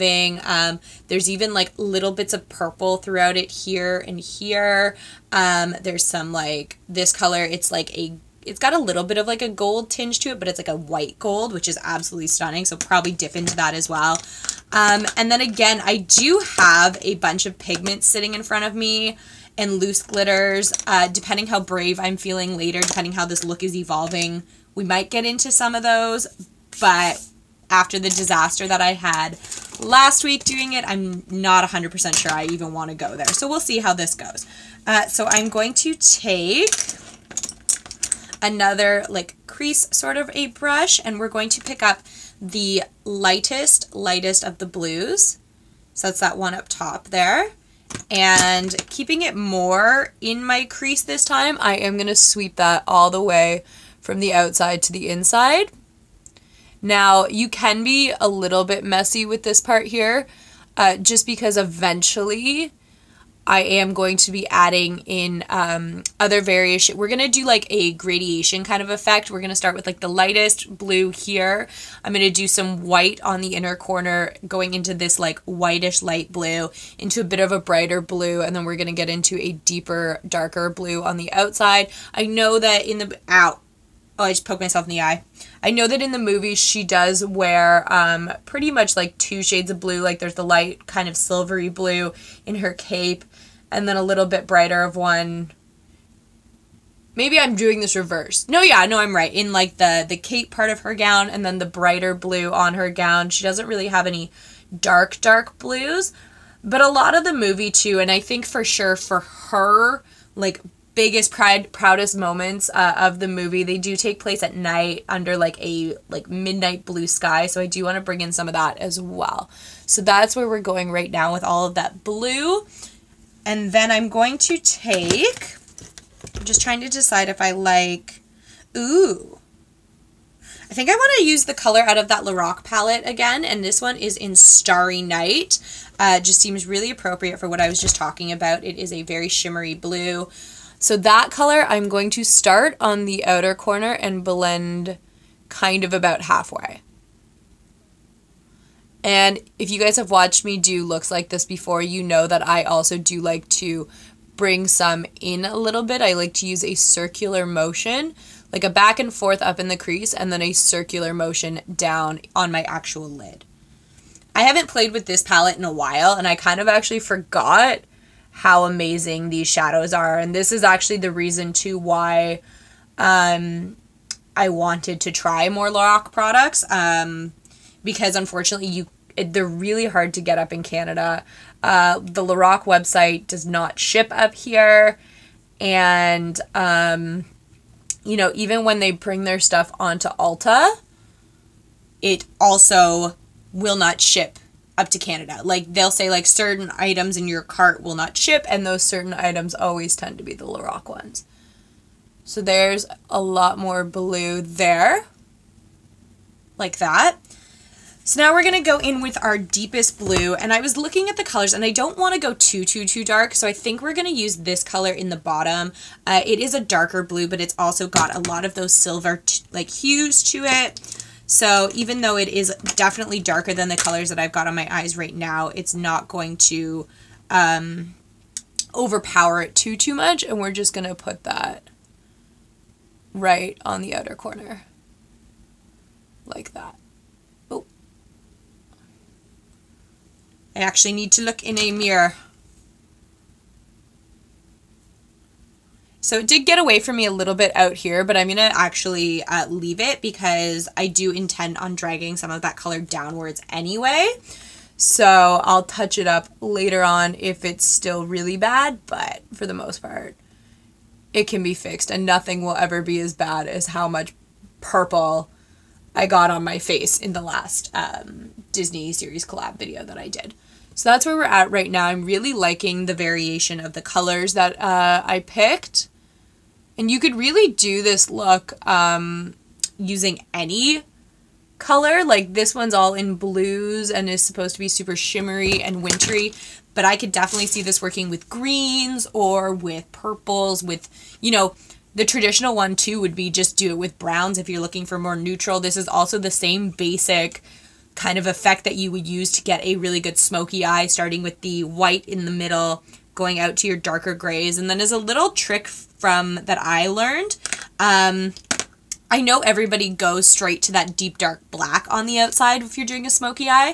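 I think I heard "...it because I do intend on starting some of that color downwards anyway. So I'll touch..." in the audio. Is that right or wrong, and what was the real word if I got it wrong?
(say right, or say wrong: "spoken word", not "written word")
wrong: "dragging", not "starting".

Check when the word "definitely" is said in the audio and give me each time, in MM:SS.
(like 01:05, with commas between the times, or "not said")
03:42, 04:47.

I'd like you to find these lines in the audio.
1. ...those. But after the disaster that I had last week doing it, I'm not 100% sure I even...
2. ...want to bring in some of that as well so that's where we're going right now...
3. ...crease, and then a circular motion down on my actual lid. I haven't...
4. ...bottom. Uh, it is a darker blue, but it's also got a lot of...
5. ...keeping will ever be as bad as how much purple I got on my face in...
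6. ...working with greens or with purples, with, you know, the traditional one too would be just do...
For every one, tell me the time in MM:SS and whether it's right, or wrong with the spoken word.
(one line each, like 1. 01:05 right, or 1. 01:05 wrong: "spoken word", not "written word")
1. 00:25 right
2. 01:57 right
3. 02:39 right
4. 03:35 right
5. 04:22 wrong: "nothing", not "keeping"
6. 04:47 right.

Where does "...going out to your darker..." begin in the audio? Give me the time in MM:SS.
05:03.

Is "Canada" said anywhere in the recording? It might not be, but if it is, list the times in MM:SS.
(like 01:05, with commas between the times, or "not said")
03:00, 03:14.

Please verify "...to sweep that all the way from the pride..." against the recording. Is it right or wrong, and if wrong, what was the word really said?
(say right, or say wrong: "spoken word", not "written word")
wrong: "outside", not "pride".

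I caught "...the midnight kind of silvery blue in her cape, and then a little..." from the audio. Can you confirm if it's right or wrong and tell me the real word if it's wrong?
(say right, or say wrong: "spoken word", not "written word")
wrong: "light", not "midnight".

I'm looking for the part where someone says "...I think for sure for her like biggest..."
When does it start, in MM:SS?
01:48.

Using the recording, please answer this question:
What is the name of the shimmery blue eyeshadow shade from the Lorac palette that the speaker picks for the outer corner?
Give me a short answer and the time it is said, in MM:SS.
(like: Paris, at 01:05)
Starry Night, at 02:14.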